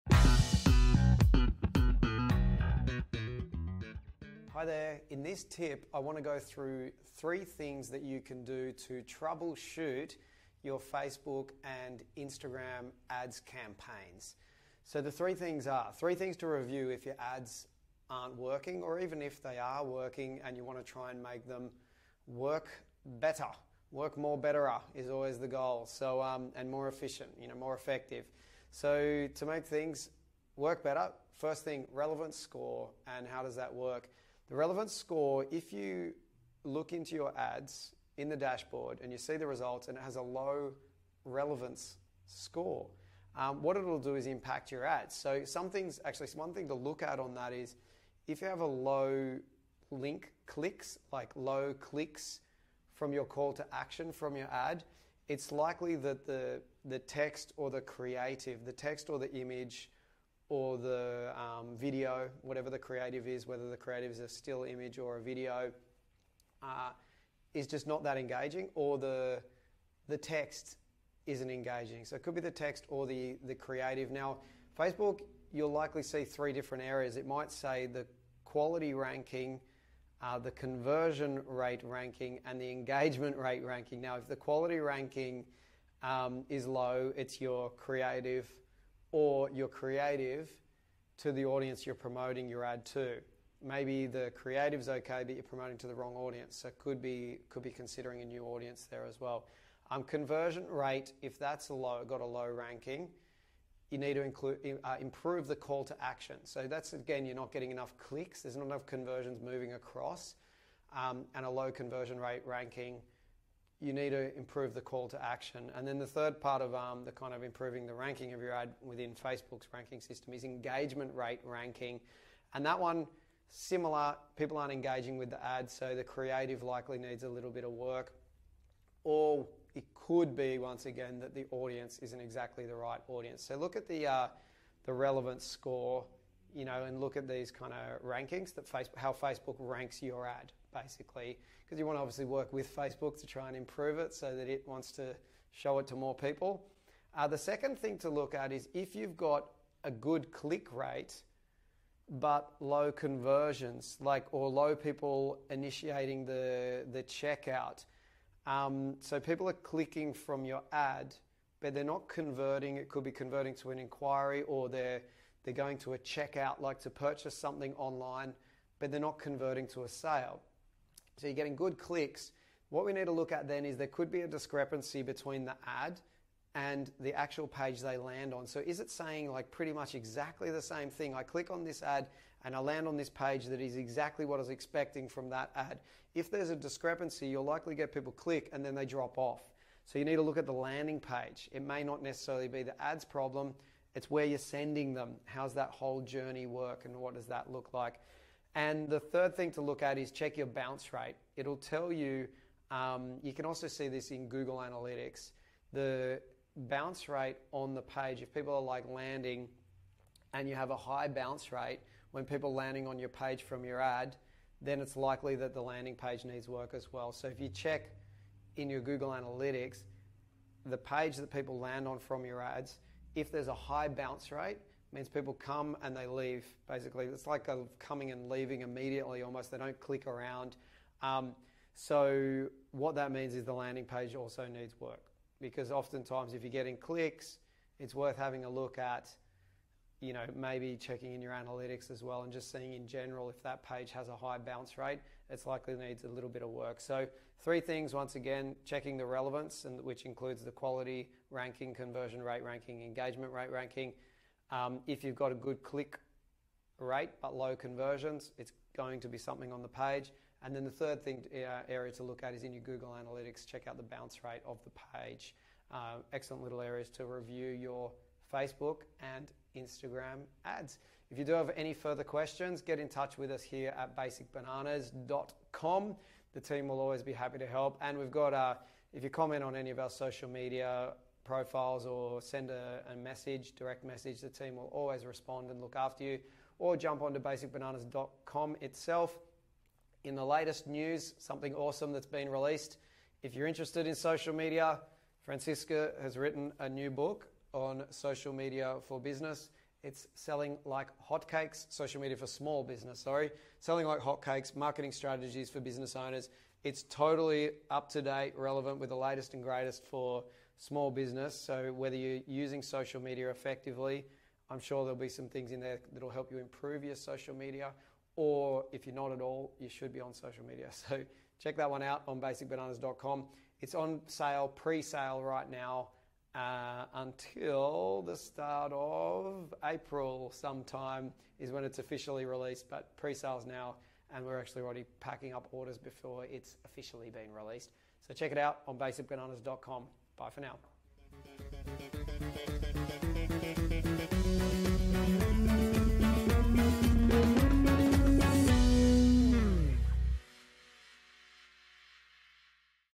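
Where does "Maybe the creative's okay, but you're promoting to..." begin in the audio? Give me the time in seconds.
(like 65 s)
93 s.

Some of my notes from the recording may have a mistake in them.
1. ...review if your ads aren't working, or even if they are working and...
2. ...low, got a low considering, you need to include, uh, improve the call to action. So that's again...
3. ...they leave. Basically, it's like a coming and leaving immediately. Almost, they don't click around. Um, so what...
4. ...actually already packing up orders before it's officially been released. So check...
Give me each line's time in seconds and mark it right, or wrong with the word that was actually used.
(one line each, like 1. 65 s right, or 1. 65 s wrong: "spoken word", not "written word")
1. 16 s right
2. 101 s wrong: "ranking", not "considering"
3. 225 s right
4. 334 s right.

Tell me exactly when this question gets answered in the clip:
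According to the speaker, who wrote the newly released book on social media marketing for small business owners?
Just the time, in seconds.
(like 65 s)
295 s.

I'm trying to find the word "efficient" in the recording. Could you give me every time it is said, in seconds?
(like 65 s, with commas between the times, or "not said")
26 s.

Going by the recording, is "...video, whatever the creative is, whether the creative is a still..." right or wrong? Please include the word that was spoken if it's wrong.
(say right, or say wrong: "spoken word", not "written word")
right.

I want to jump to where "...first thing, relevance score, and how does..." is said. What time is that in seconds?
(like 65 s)
31 s.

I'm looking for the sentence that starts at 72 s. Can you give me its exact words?
So it could be the text or the the creative.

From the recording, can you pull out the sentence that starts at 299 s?
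It's selling like hotcakes, social media for small business, sorry.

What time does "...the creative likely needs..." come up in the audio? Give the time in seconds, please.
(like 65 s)
125 s.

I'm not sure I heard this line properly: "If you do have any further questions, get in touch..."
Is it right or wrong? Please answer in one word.
right.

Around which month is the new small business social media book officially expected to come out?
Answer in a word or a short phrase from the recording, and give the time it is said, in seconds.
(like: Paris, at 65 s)
April, at 329 s.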